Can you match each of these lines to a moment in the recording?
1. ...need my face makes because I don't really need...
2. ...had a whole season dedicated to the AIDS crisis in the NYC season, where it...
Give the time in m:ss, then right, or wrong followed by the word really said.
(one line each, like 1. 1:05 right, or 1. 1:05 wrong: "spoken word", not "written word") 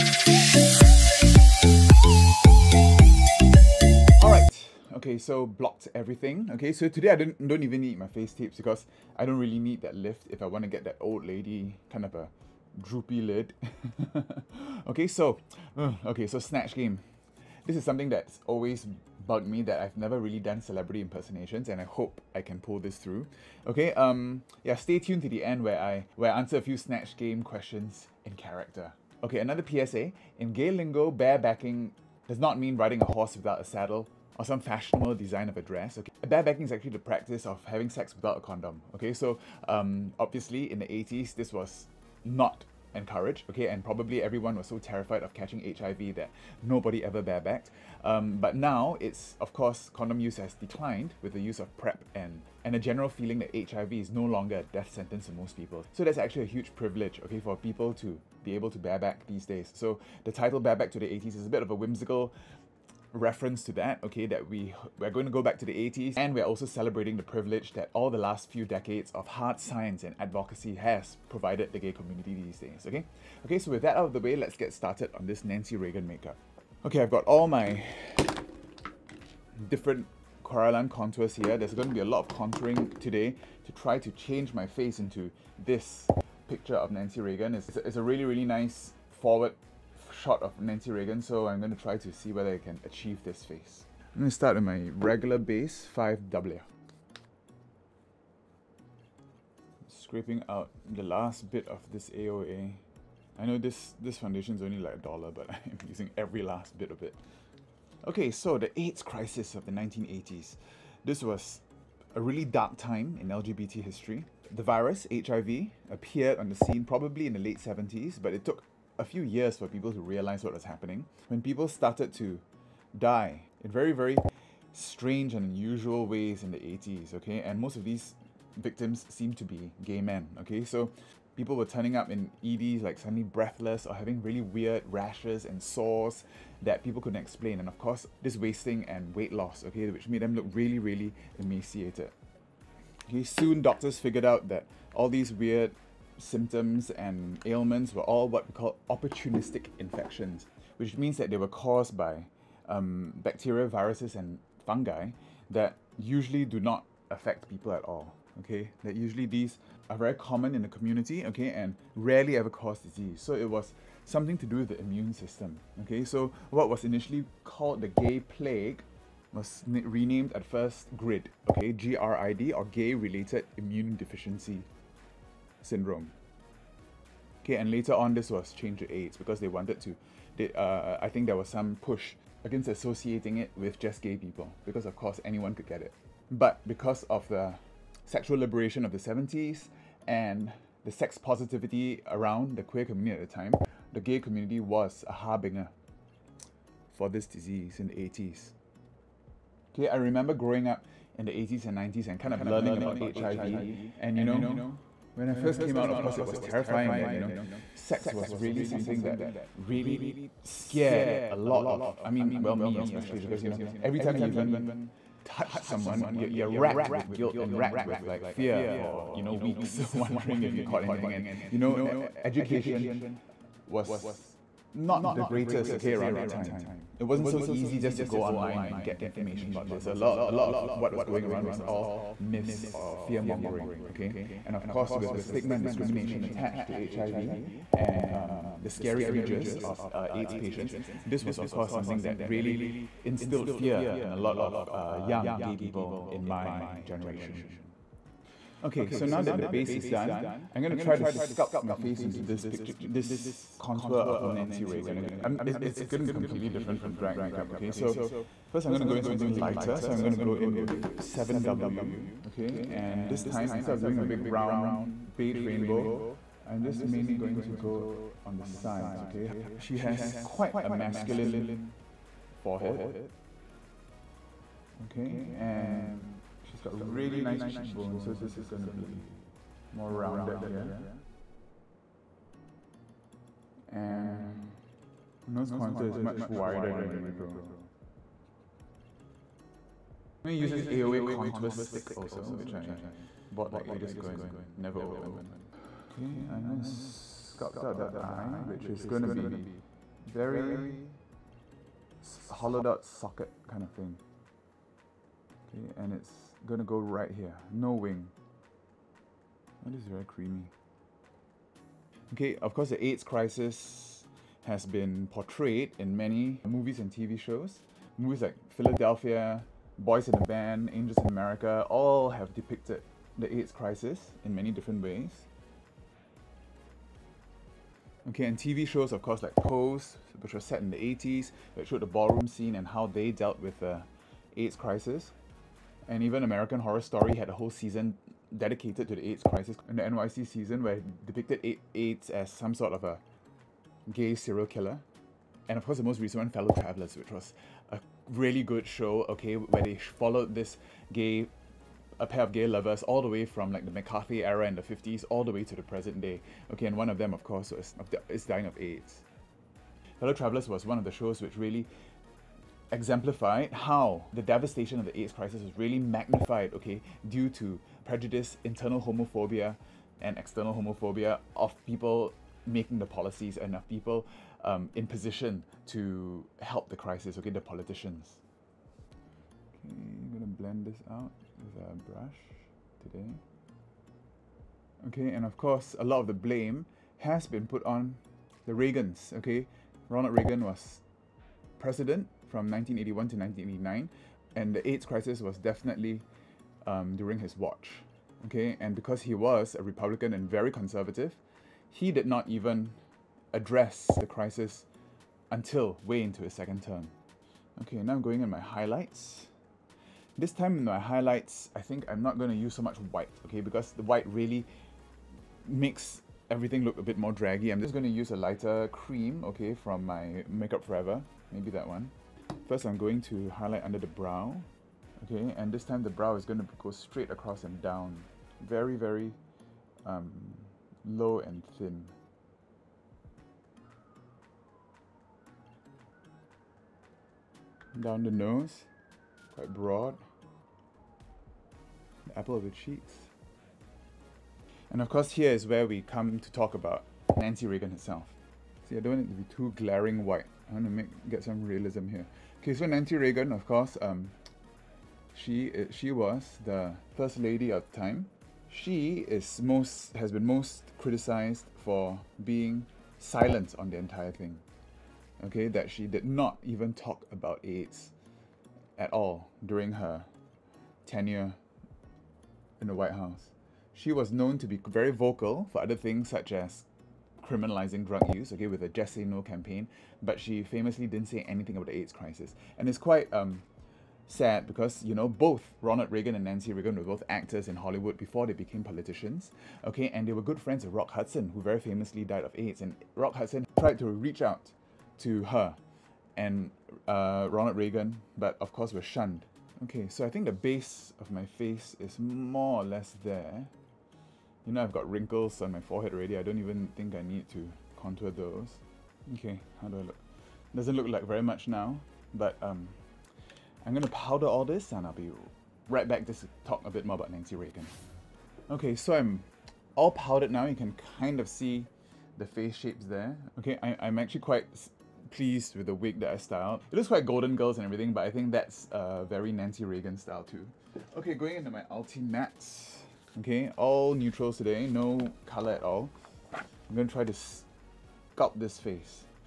1. 0:07 wrong: "tapes", not "makes"
2. 5:37 right.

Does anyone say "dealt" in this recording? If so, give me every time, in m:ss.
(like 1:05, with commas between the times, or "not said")
5:33.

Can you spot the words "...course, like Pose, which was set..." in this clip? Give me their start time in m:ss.
5:29.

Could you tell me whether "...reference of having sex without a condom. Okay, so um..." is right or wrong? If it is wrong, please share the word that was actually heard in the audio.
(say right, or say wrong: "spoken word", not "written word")
wrong: "practice", not "reference".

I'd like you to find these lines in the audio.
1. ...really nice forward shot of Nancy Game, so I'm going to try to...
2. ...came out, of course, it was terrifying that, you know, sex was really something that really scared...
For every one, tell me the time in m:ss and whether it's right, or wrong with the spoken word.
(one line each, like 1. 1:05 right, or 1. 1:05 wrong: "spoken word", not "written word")
1. 1:28 wrong: "Reagan", not "Game"
2. 3:25 right.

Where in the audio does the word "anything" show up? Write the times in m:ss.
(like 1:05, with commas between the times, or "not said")
3:40, 8:01.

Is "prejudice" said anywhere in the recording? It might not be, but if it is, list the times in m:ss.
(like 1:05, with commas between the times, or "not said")
6:07.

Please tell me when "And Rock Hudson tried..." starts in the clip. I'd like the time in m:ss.
8:12.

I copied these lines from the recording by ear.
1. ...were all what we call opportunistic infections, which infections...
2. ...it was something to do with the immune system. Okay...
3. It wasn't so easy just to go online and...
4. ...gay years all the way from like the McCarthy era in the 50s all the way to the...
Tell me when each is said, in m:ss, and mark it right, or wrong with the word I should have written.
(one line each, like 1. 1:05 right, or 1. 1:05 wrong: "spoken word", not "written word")
1. 2:27 wrong: "means", not "infections"
2. 2:43 right
3. 3:46 right
4. 5:52 wrong: "lovers", not "years".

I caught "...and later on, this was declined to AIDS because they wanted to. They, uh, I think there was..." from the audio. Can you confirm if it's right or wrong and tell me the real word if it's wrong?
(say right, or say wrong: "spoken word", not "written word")
wrong: "changed", not "declined".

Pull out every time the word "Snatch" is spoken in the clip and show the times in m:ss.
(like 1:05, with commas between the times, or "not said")
0:16, 0:26.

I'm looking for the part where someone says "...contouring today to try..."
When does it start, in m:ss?
1:22.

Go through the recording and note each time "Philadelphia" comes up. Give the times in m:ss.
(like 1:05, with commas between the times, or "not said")
5:18.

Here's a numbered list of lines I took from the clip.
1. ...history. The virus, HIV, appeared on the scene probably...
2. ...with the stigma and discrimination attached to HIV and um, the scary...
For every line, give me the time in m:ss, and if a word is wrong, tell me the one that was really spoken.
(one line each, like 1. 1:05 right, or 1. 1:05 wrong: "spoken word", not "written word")
1. 1:53 right
2. 3:54 right.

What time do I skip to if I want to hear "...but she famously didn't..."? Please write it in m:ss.
8:00.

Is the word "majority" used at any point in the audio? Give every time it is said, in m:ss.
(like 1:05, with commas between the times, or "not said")
not said.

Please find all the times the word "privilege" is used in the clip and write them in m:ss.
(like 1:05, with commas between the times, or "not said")
0:56, 1:07.